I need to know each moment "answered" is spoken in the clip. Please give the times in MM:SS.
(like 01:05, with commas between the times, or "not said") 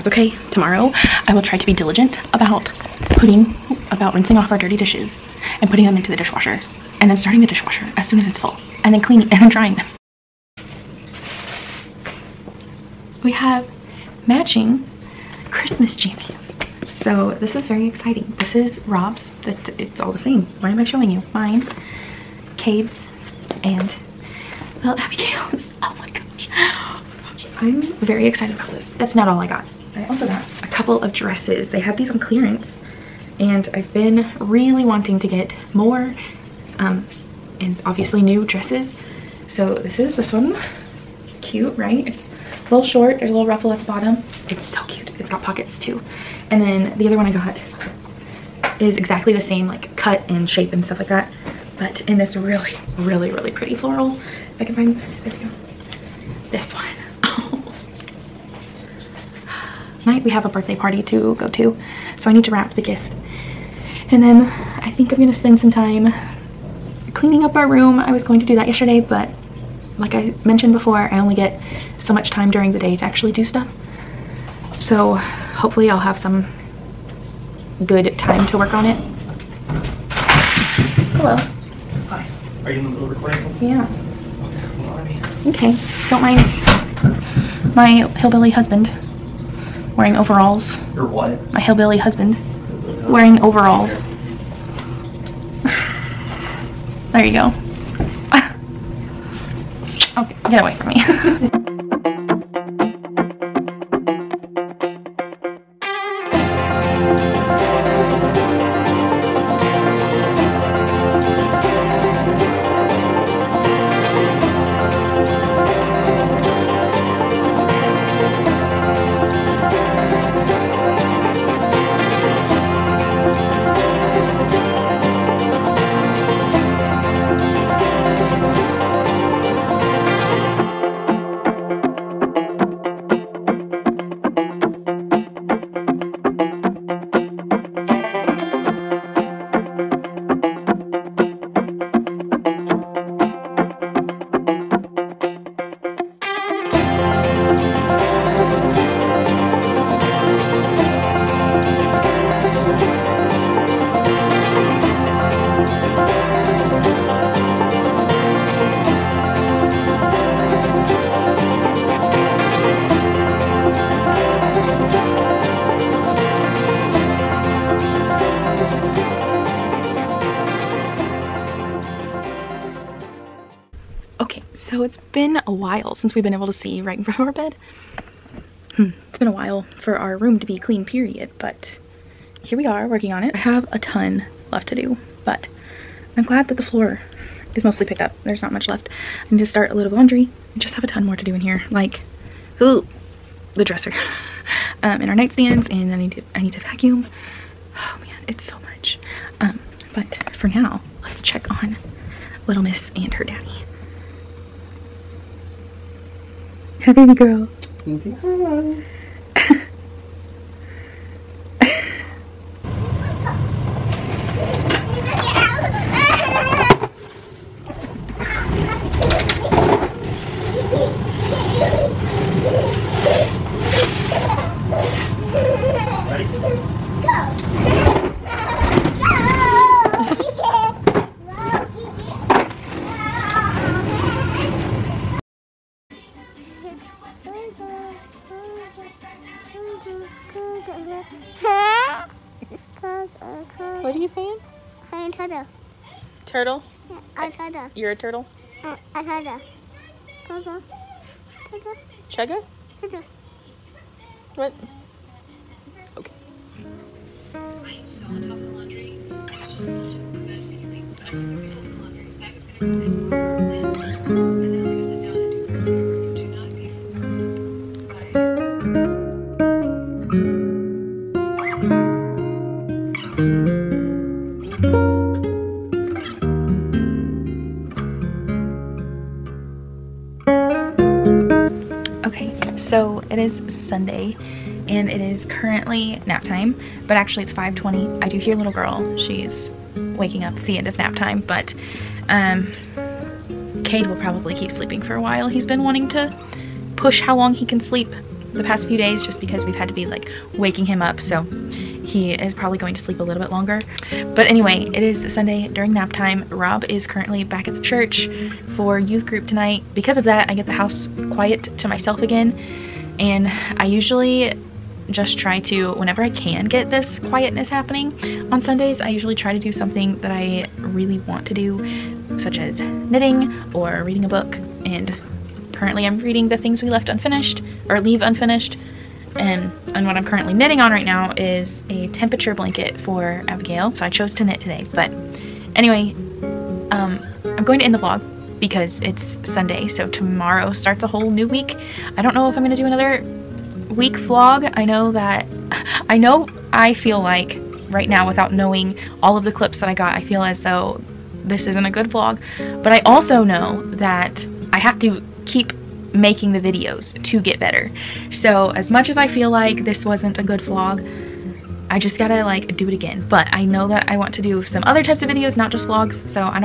not said.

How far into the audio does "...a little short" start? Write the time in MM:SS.
00:42.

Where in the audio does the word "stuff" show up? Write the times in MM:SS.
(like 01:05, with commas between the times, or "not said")
00:50, 01:13.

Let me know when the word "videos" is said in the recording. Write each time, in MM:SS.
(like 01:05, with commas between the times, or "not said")
05:56, 06:05.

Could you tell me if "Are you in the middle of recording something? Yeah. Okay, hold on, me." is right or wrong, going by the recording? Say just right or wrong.
right.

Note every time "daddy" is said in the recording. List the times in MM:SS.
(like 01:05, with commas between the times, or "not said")
03:23.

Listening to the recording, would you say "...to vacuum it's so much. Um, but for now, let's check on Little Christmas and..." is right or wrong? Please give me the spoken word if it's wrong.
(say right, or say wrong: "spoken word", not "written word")
wrong: "Miss", not "Christmas".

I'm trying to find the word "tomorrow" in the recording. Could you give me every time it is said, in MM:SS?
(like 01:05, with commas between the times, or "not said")
00:00, 05:39.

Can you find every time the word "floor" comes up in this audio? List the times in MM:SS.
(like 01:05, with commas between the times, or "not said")
03:06.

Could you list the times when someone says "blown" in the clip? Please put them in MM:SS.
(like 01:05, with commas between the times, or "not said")
not said.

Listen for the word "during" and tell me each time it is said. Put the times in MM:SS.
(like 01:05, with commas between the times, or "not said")
01:12, 05:05.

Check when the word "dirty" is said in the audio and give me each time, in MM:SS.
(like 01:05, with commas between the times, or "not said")
00:04.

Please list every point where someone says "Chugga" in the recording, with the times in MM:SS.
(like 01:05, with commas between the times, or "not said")
04:12.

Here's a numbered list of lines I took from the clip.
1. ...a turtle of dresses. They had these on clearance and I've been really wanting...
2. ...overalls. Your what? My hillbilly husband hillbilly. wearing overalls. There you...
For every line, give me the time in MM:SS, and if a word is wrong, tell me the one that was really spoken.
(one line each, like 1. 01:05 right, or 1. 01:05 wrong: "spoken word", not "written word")
1. 00:30 wrong: "couple", not "turtle"
2. 01:30 right.